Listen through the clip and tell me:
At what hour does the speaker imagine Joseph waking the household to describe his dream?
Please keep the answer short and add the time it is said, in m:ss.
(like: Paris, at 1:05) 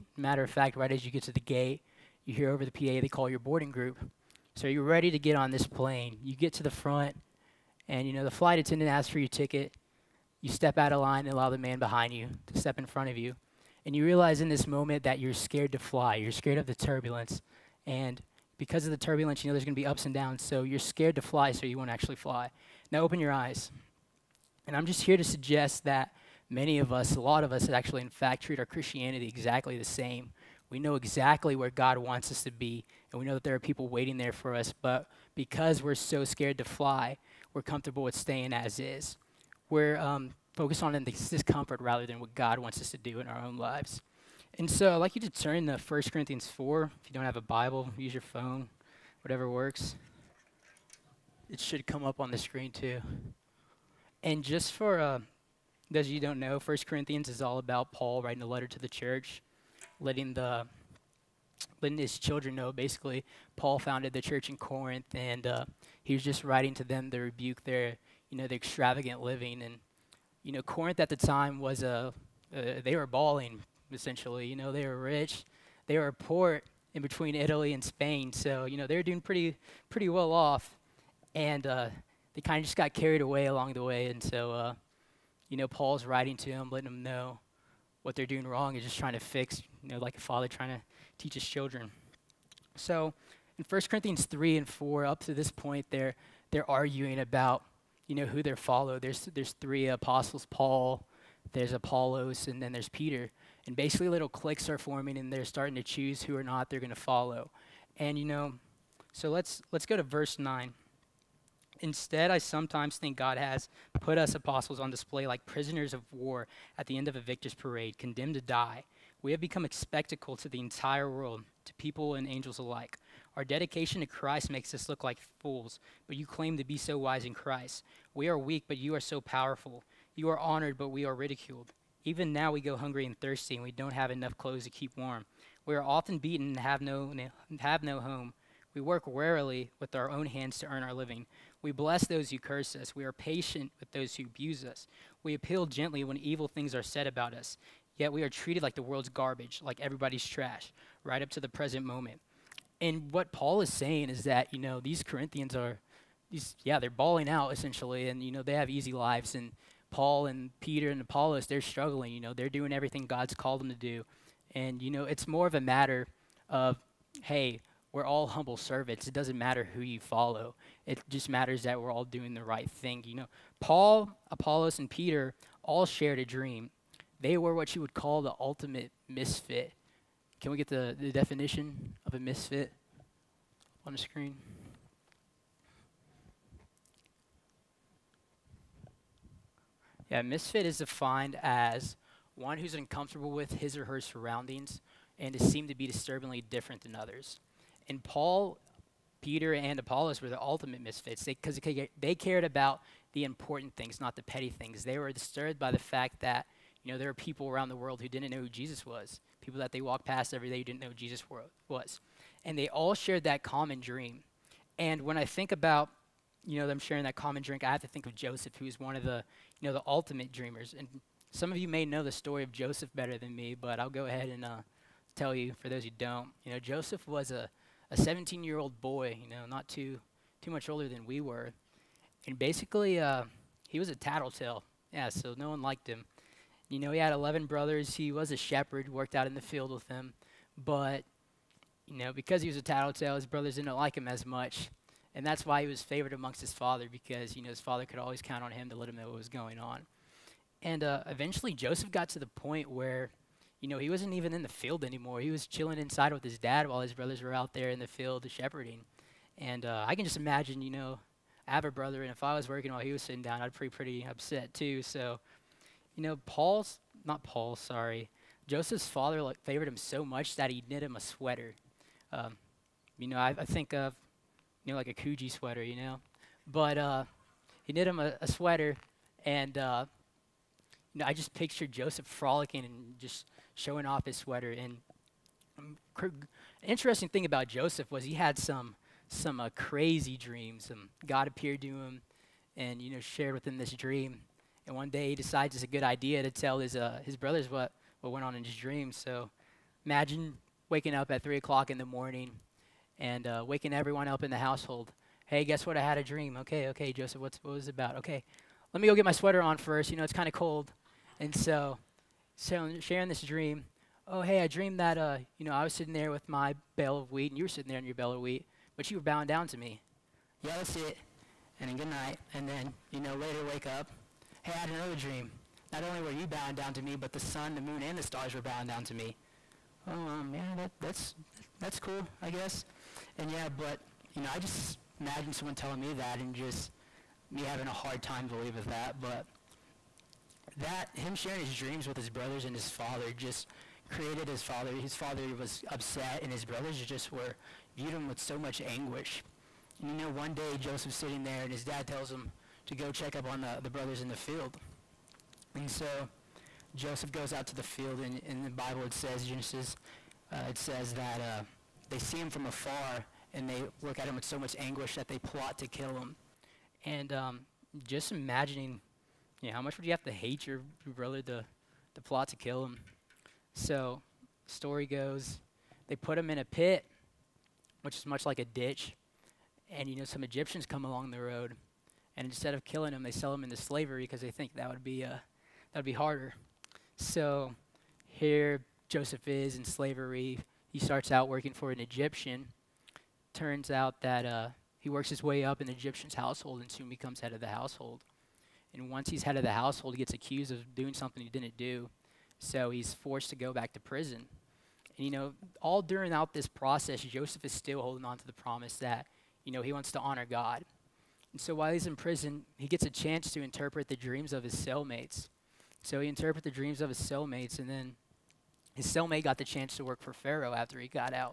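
3 o'clock, at 5:01.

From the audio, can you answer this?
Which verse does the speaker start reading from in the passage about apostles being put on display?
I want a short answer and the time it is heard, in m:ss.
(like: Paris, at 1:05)
9, at 1:50.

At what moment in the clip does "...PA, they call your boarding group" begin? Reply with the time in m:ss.
0:02.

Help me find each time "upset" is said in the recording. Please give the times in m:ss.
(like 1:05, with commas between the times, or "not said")
4:24, 5:45.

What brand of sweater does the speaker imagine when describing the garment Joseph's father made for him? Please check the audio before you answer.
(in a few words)
Coogi.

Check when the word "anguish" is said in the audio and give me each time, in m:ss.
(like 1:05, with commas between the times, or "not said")
5:48, 6:04.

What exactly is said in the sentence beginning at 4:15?
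He was chilling inside with his dad while his brothers were out there in the field shepherding.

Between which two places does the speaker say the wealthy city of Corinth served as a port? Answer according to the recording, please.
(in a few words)
Italy and Spain.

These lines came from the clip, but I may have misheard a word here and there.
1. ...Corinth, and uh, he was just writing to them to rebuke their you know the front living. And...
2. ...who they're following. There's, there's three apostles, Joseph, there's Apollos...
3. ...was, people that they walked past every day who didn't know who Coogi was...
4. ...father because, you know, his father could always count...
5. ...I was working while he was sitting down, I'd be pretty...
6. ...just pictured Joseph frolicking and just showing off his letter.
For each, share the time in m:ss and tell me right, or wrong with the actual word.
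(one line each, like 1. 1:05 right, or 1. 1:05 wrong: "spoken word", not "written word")
1. 1:04 wrong: "extravagant", not "front"
2. 1:38 wrong: "Paul", not "Joseph"
3. 3:28 wrong: "Jesus", not "Coogi"
4. 4:06 right
5. 4:22 right
6. 4:41 wrong: "sweater", not "letter".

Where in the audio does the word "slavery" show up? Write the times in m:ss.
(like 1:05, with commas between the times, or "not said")
6:23, 6:29.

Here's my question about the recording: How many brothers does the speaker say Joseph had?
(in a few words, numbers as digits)
11.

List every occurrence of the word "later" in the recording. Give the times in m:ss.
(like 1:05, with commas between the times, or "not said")
5:23.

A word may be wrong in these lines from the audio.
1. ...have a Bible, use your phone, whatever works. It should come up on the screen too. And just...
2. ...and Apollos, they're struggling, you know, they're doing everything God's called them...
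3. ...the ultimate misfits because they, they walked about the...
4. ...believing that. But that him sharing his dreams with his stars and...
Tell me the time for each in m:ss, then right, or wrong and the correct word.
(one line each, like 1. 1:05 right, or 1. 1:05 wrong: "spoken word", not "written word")
1. 0:47 right
2. 2:40 right
3. 3:20 wrong: "cared", not "walked"
4. 5:38 wrong: "brothers", not "stars".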